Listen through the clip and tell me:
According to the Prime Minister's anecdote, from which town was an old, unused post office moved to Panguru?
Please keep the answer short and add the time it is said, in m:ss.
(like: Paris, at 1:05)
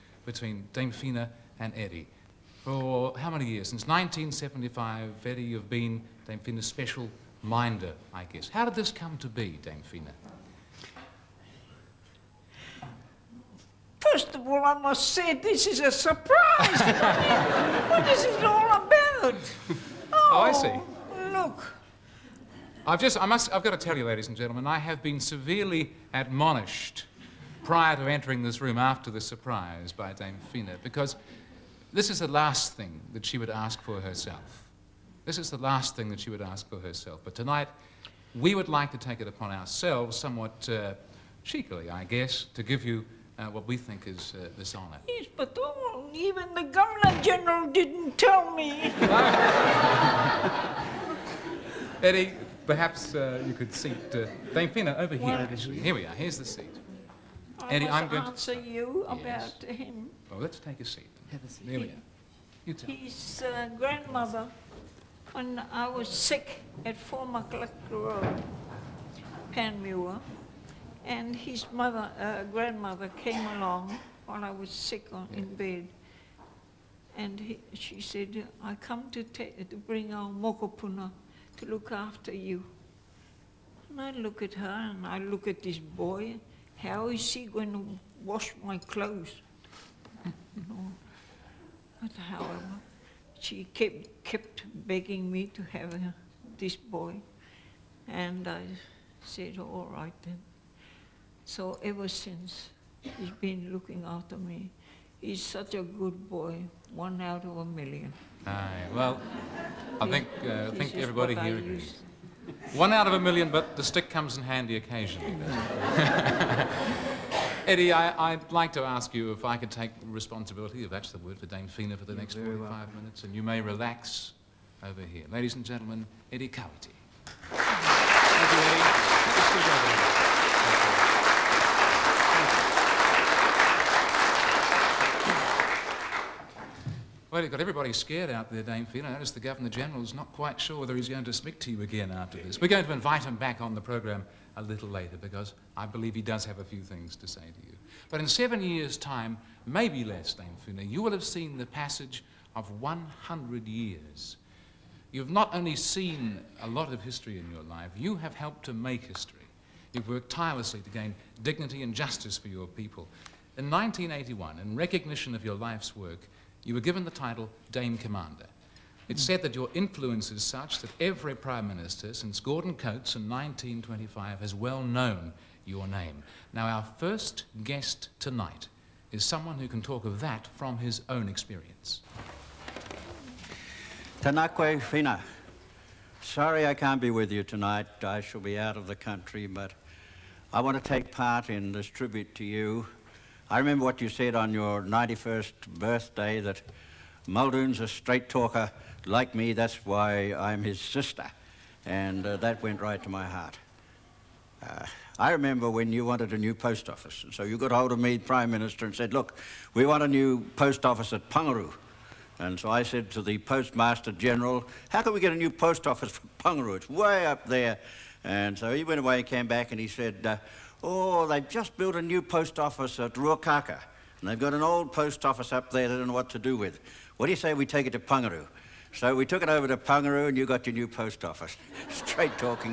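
Ruakaka, at 3:43.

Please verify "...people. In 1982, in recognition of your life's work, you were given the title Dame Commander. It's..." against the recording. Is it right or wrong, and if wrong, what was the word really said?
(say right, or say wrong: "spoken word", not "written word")
wrong: "1981", not "1982".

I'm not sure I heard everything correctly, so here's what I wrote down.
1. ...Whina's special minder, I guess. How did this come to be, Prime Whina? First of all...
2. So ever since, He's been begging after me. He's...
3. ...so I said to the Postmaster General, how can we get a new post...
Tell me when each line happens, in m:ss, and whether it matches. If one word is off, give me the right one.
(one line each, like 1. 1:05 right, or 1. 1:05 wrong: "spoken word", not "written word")
1. 0:06 wrong: "Dame", not "Prime"
2. 1:41 wrong: "looking", not "begging"
3. 3:32 right.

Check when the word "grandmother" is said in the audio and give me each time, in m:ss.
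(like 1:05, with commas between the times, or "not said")
1:03, 1:12.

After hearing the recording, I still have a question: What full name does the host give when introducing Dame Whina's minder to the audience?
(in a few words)
Eddie Kawiti.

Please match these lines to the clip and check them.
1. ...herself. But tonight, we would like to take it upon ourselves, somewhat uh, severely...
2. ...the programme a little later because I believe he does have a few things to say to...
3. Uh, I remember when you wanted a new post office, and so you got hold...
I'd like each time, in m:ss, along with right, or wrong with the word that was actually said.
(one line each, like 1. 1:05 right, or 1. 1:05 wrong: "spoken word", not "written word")
1. 0:36 wrong: "cheekily", not "severely"
2. 2:23 right
3. 3:24 right.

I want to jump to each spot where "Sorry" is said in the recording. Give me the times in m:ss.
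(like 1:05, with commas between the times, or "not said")
3:06.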